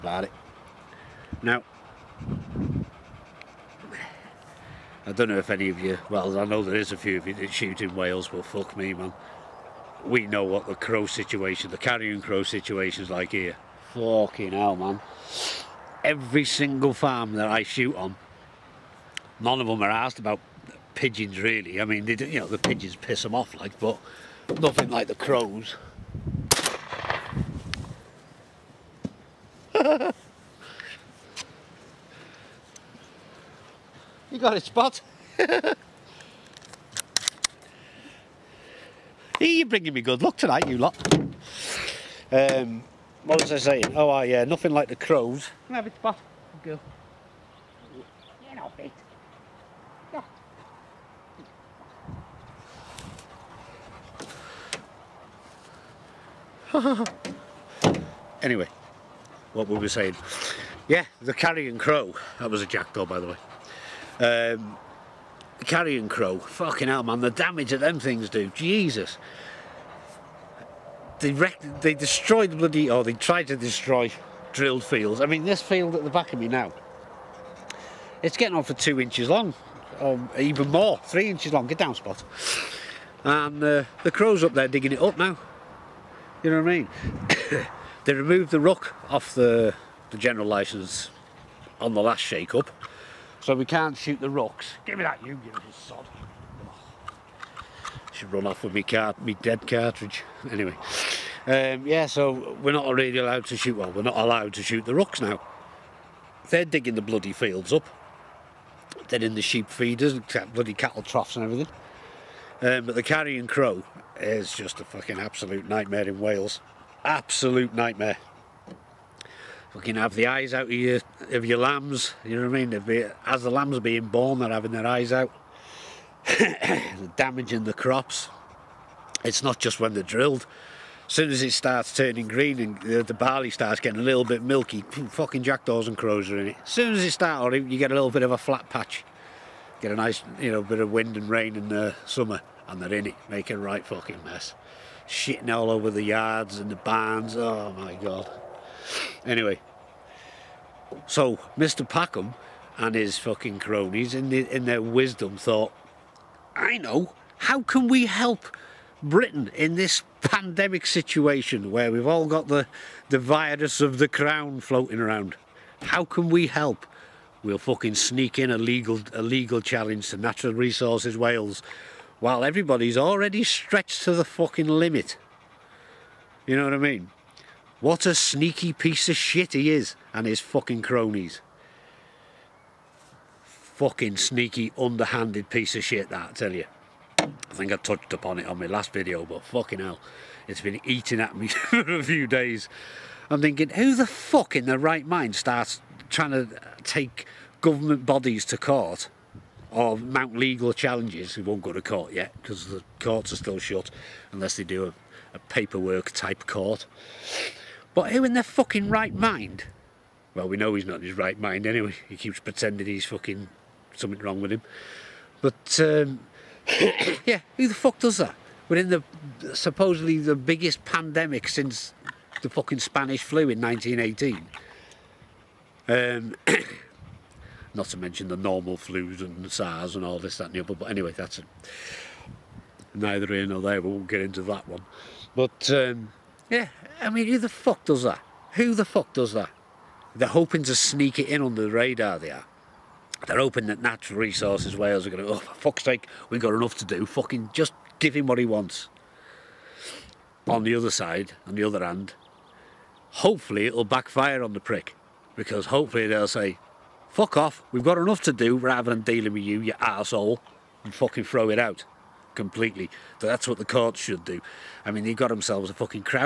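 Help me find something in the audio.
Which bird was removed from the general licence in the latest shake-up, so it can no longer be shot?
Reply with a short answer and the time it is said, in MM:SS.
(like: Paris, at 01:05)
Rook, at 01:28.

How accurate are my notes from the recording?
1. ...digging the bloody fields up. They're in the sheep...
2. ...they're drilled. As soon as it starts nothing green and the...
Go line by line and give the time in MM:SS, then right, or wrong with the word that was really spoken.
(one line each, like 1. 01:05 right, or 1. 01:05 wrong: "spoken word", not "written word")
1. 01:46 right
2. 02:09 wrong: "turning", not "nothing".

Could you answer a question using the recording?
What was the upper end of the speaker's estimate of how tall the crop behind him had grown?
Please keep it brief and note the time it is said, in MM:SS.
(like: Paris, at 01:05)
3 inches, at 01:21.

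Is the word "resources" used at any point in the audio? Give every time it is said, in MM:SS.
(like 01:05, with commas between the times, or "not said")
02:50, 04:04.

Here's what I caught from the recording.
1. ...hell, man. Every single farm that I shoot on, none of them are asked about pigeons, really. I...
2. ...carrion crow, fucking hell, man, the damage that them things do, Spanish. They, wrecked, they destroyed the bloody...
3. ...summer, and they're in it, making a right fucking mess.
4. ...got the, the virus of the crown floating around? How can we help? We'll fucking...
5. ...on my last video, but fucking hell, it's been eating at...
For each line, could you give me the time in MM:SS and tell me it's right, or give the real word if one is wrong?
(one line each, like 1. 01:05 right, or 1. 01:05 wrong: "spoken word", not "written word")
1. 00:14 right
2. 01:05 wrong: "Jesus", not "Spanish"
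3. 02:22 right
4. 02:42 right
5. 03:08 right.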